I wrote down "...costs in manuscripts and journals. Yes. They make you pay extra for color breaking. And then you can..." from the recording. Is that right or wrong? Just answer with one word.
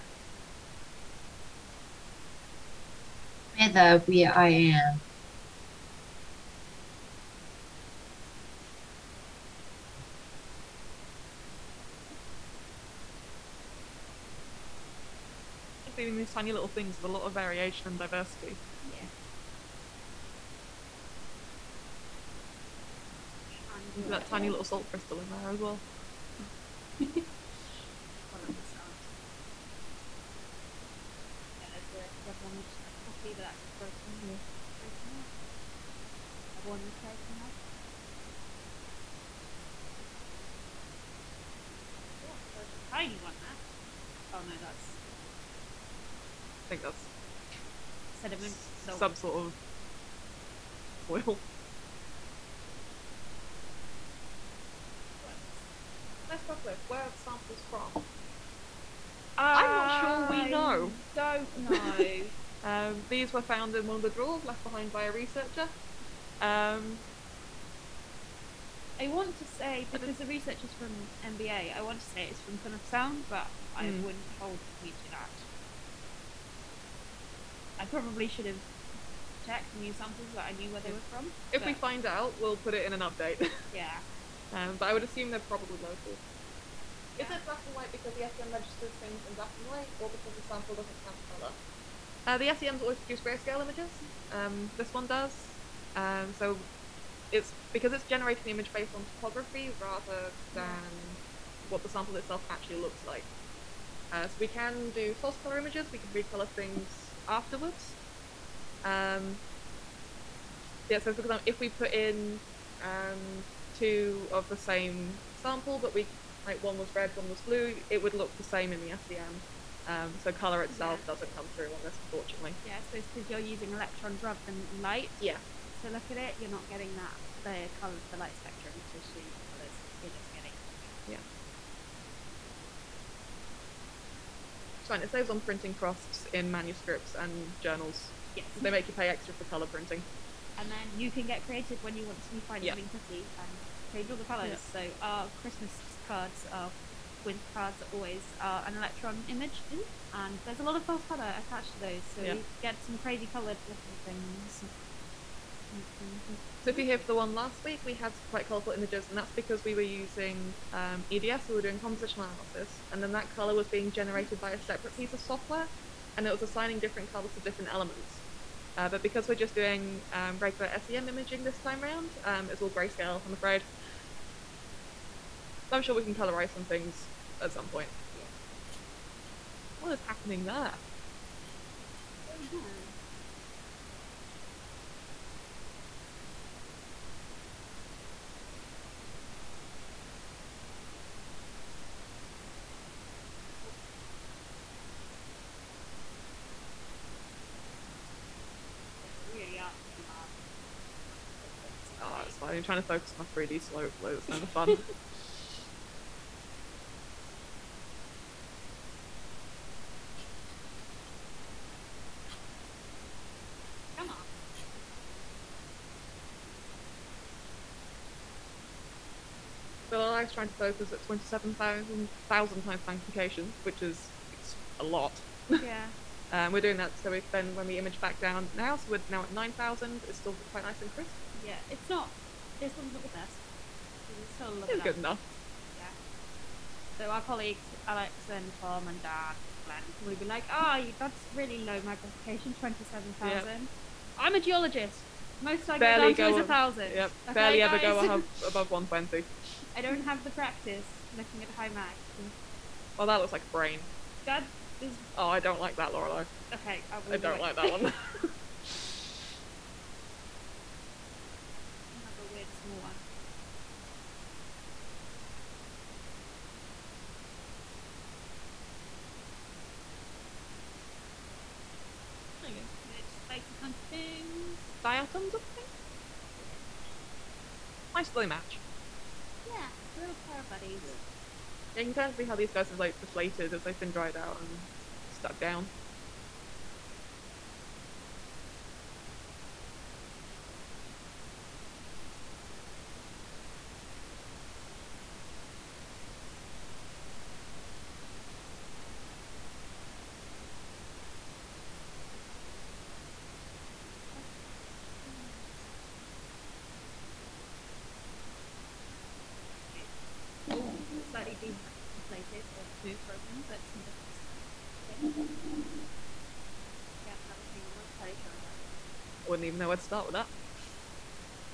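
wrong.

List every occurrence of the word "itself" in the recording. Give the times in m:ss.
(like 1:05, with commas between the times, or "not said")
1:42, 2:00.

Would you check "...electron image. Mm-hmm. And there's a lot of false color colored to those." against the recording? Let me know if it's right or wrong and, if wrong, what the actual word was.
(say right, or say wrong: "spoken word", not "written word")
wrong: "attached", not "colored".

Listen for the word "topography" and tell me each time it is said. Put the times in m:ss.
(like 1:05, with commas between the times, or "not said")
1:39.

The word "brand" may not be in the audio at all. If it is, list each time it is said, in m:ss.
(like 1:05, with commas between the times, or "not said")
not said.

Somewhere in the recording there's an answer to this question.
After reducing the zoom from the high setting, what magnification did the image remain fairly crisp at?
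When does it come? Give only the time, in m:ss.
3:49.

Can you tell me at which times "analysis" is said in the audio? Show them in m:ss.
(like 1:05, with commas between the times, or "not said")
2:42.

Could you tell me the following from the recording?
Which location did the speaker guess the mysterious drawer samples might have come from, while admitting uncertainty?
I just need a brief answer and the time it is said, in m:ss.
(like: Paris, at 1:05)
Plymouth Sound, at 1:12.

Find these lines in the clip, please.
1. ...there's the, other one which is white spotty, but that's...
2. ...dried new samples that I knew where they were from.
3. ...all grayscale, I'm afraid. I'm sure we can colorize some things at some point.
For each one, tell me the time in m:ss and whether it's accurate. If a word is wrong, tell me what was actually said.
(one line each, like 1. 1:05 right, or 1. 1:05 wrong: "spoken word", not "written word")
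1. 0:31 wrong: "quite", not "white"
2. 1:19 wrong: "checked", not "dried"
3. 2:52 right.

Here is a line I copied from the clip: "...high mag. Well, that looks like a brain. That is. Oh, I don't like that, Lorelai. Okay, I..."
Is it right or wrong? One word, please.
right.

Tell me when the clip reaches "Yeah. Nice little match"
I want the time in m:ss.
4:36.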